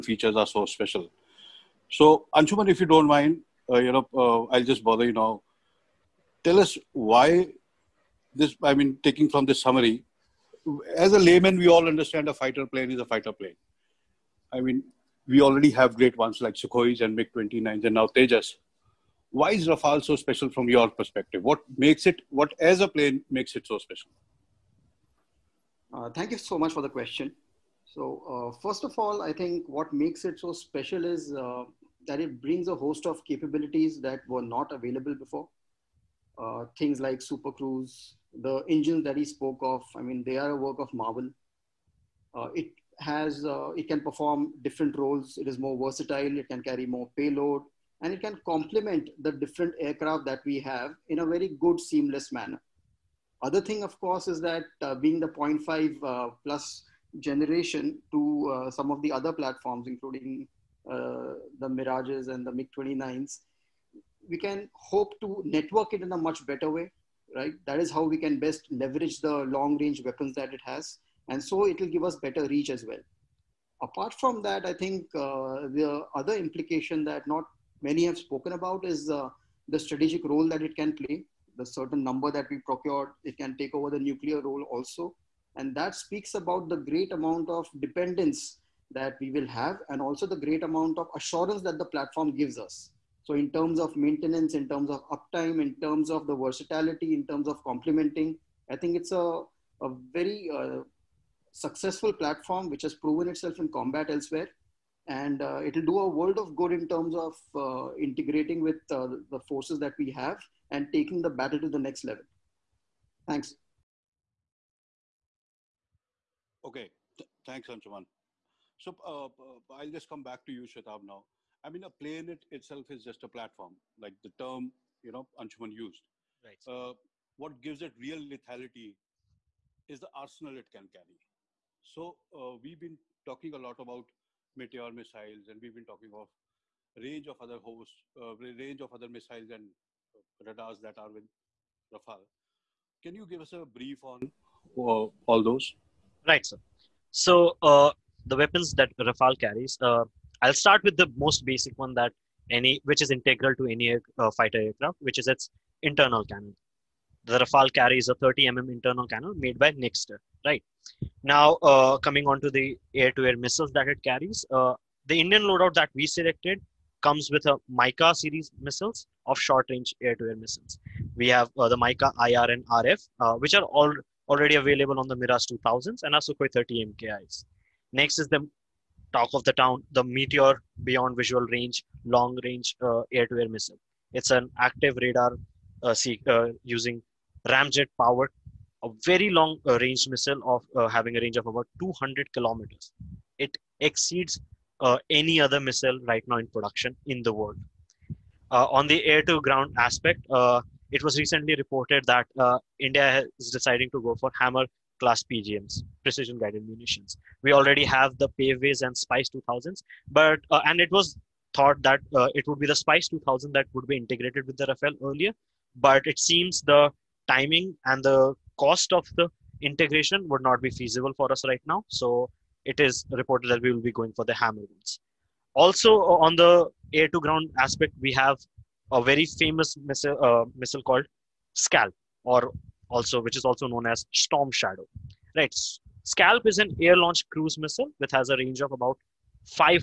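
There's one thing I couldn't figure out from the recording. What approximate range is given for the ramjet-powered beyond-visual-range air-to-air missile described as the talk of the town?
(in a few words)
200 kilometers.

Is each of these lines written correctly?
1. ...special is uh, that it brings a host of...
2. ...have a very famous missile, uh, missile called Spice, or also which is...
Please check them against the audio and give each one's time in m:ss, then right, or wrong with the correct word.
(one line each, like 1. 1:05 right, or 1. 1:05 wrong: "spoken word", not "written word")
1. 0:30 right
2. 3:48 wrong: "Scalp", not "Spice".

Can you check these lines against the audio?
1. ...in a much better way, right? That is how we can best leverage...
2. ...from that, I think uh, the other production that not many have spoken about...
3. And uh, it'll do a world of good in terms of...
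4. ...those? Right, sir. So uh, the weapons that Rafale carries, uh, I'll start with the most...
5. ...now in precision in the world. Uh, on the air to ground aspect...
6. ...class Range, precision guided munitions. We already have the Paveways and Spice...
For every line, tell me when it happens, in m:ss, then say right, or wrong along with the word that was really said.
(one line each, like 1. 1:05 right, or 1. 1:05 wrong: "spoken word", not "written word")
1. 1:06 right
2. 1:14 wrong: "implication", not "production"
3. 1:45 right
4. 2:25 right
5. 3:16 wrong: "production", not "precision"
6. 3:24 wrong: "PGMs", not "Range".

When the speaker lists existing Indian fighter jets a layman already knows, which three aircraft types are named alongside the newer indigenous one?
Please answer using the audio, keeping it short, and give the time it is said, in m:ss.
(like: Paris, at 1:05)
Sukhois, MiG-29s, Tejas, at 0:16.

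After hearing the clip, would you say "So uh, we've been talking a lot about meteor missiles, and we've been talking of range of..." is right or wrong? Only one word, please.
right.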